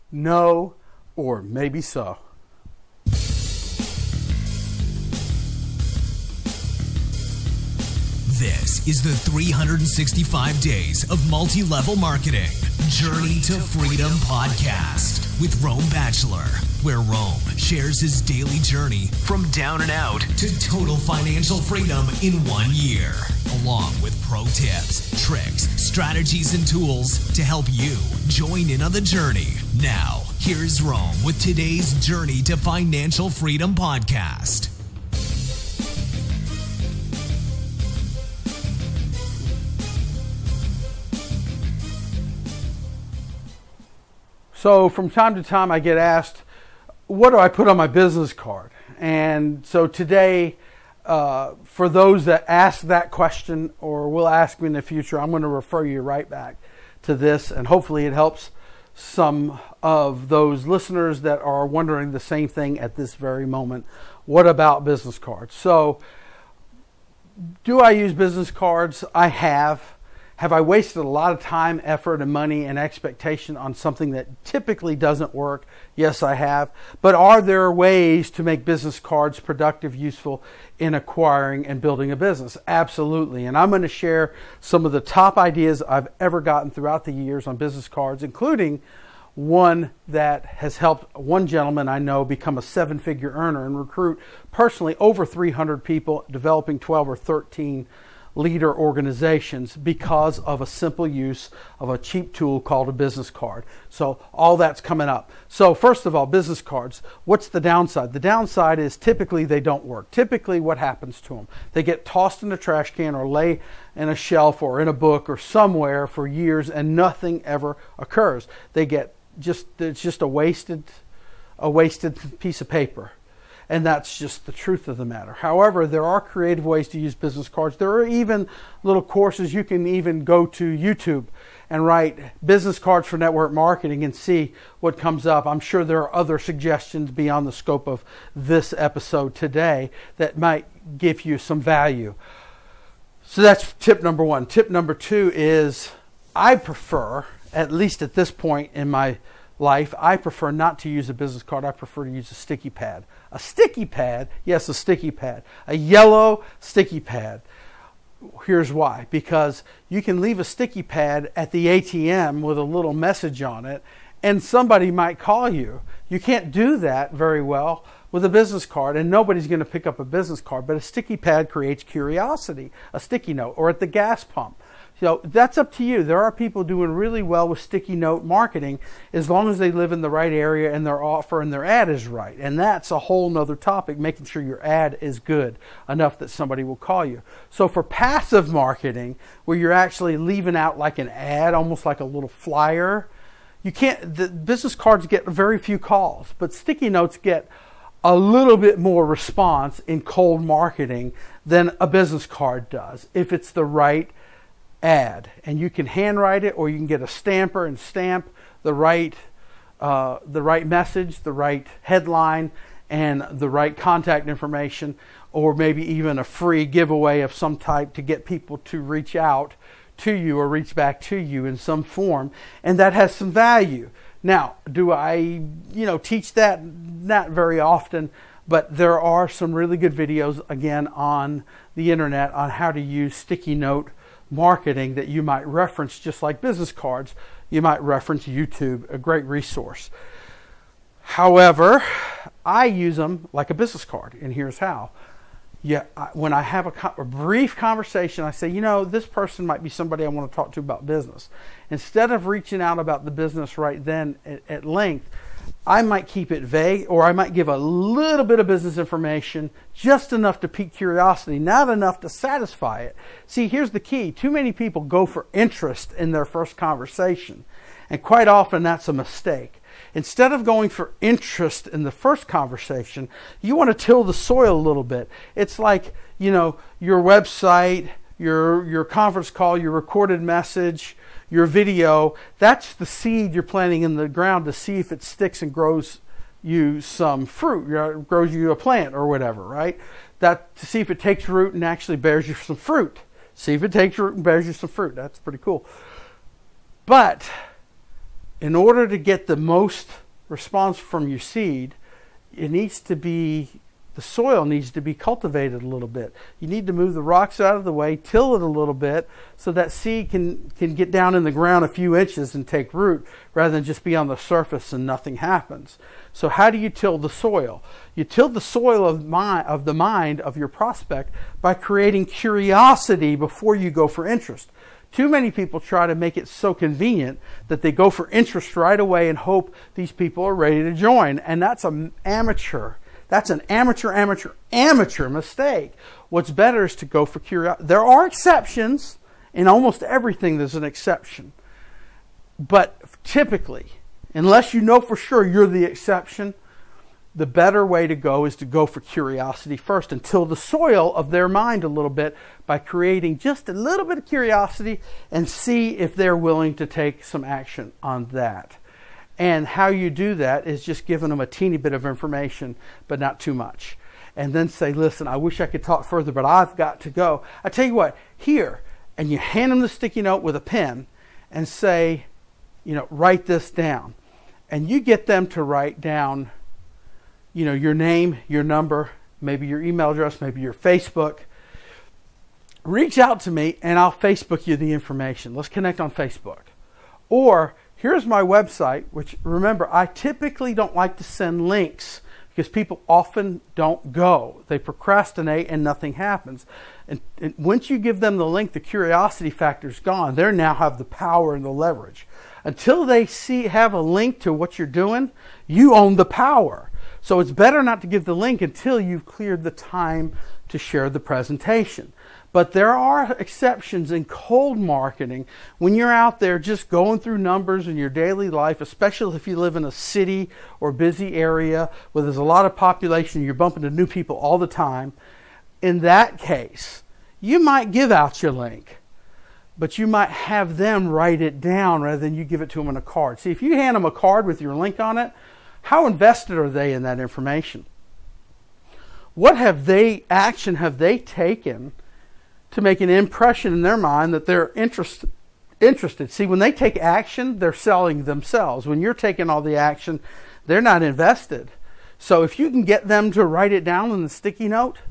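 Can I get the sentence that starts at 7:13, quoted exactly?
See, if you hand them a card with your link on it, how invested are they in that information?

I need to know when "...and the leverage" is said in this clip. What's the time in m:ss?
6:41.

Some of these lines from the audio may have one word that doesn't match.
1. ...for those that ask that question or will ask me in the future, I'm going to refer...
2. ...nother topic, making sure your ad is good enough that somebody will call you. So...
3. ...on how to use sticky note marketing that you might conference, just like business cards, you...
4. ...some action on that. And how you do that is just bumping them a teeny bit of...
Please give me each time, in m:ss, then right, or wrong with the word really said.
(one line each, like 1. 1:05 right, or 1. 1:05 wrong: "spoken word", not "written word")
1. 0:51 right
2. 3:03 right
3. 3:52 wrong: "reference", not "conference"
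4. 5:57 wrong: "giving", not "bumping".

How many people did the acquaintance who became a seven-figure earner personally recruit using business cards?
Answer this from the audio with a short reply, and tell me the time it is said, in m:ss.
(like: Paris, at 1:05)
over 300, at 1:34.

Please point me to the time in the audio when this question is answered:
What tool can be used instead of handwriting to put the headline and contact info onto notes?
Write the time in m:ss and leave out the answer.
3:27.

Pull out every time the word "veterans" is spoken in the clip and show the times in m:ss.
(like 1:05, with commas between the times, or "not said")
not said.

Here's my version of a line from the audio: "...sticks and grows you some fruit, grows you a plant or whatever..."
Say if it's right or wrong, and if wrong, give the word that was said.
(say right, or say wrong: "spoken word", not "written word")
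right.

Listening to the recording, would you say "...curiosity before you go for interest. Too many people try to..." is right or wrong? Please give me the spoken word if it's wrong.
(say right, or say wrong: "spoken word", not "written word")
right.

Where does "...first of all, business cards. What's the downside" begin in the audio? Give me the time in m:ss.
1:45.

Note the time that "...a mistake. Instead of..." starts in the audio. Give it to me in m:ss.
4:28.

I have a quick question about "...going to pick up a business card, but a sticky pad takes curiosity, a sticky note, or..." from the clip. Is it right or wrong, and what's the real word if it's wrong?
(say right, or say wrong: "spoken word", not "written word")
wrong: "creates", not "takes".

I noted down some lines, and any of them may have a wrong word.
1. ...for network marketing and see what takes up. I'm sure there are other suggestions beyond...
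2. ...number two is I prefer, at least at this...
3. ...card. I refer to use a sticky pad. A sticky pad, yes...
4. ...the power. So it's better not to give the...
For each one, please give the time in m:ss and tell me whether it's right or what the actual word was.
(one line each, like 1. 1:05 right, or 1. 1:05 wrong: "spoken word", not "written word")
1. 2:13 wrong: "comes", not "takes"
2. 2:24 right
3. 2:31 wrong: "prefer", not "refer"
4. 6:45 right.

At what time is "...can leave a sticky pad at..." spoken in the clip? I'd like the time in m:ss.
2:40.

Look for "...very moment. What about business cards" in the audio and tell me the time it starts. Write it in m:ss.
1:03.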